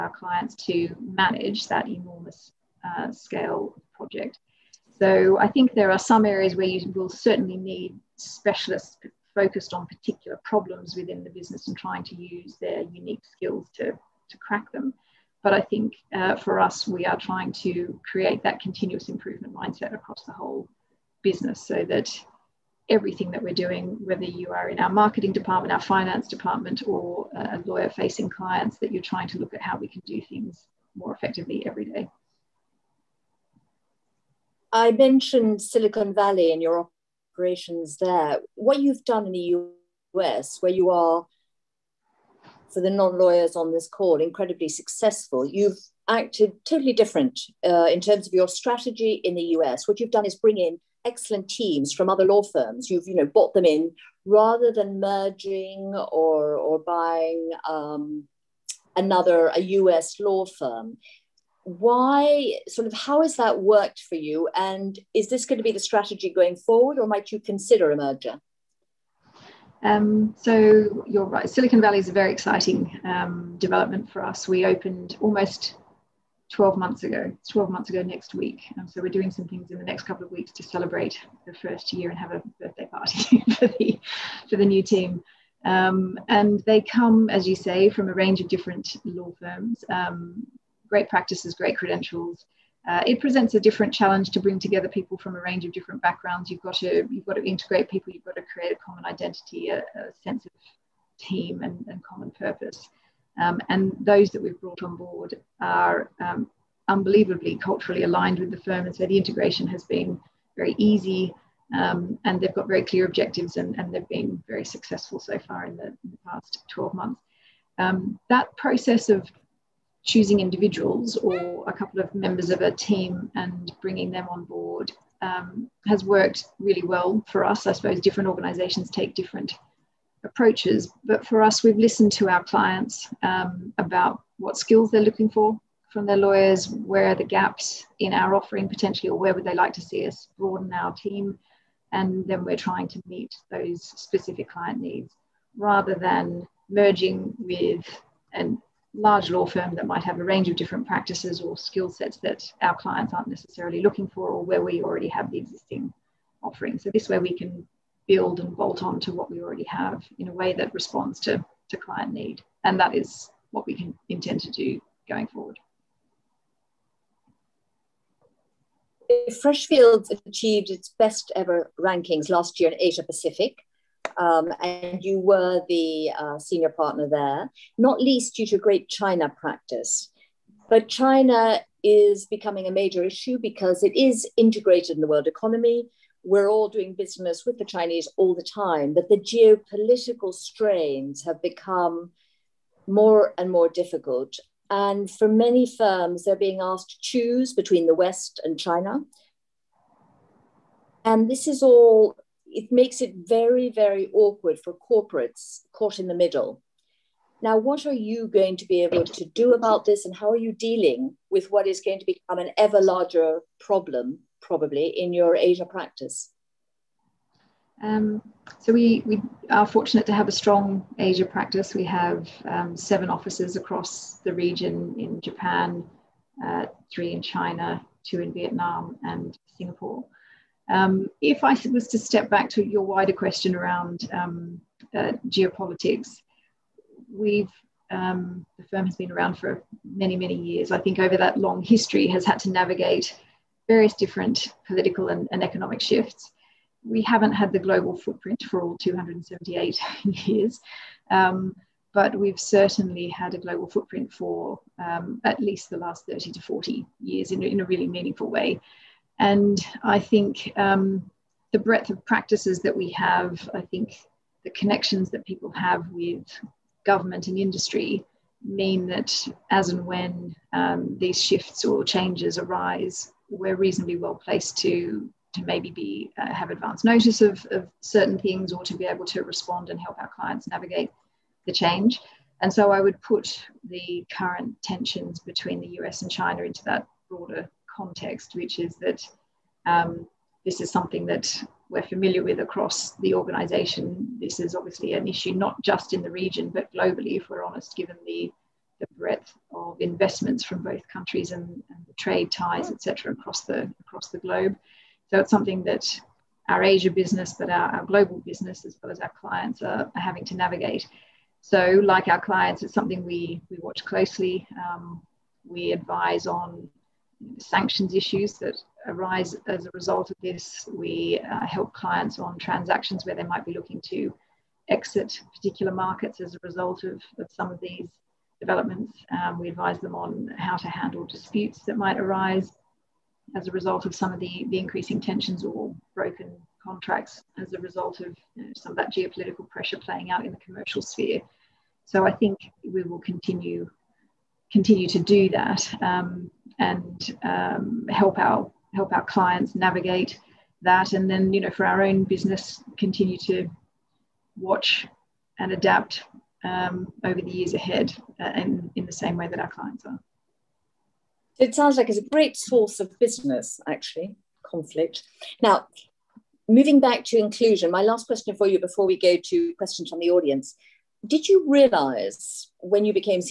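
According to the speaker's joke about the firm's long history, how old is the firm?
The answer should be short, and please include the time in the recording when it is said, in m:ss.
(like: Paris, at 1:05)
278, at 4:08.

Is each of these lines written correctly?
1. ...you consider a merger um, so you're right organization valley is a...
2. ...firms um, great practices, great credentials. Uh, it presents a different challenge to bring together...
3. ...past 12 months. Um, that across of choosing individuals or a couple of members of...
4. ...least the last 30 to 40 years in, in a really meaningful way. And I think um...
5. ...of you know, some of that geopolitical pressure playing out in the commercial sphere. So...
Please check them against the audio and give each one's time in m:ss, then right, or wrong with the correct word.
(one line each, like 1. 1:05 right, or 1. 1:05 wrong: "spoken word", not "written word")
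1. 1:07 wrong: "silicon", not "organization"
2. 1:29 right
3. 1:56 wrong: "process", not "across"
4. 4:15 right
5. 5:37 right.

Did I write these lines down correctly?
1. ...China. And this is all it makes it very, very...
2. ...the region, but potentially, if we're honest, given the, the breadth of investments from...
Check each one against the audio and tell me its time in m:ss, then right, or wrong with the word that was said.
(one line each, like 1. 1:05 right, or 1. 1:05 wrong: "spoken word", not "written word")
1. 3:18 right
2. 4:56 wrong: "globally", not "potentially".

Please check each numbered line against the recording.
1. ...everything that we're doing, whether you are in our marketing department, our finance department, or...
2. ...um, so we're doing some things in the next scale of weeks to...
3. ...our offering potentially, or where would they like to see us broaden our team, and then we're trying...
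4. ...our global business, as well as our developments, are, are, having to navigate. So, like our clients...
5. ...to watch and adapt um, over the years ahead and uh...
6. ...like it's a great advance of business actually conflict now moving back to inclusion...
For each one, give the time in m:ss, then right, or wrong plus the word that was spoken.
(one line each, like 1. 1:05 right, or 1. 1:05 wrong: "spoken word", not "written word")
1. 0:22 right
2. 1:18 wrong: "couple", not "scale"
3. 2:18 right
4. 5:07 wrong: "clients", not "developments"
5. 5:53 right
6. 6:01 wrong: "source", not "advance".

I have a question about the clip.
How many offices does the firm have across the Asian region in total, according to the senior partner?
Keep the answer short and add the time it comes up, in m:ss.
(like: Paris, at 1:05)
7, at 3:42.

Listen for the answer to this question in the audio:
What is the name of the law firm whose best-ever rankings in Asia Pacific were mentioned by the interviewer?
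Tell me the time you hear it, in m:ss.
2:49.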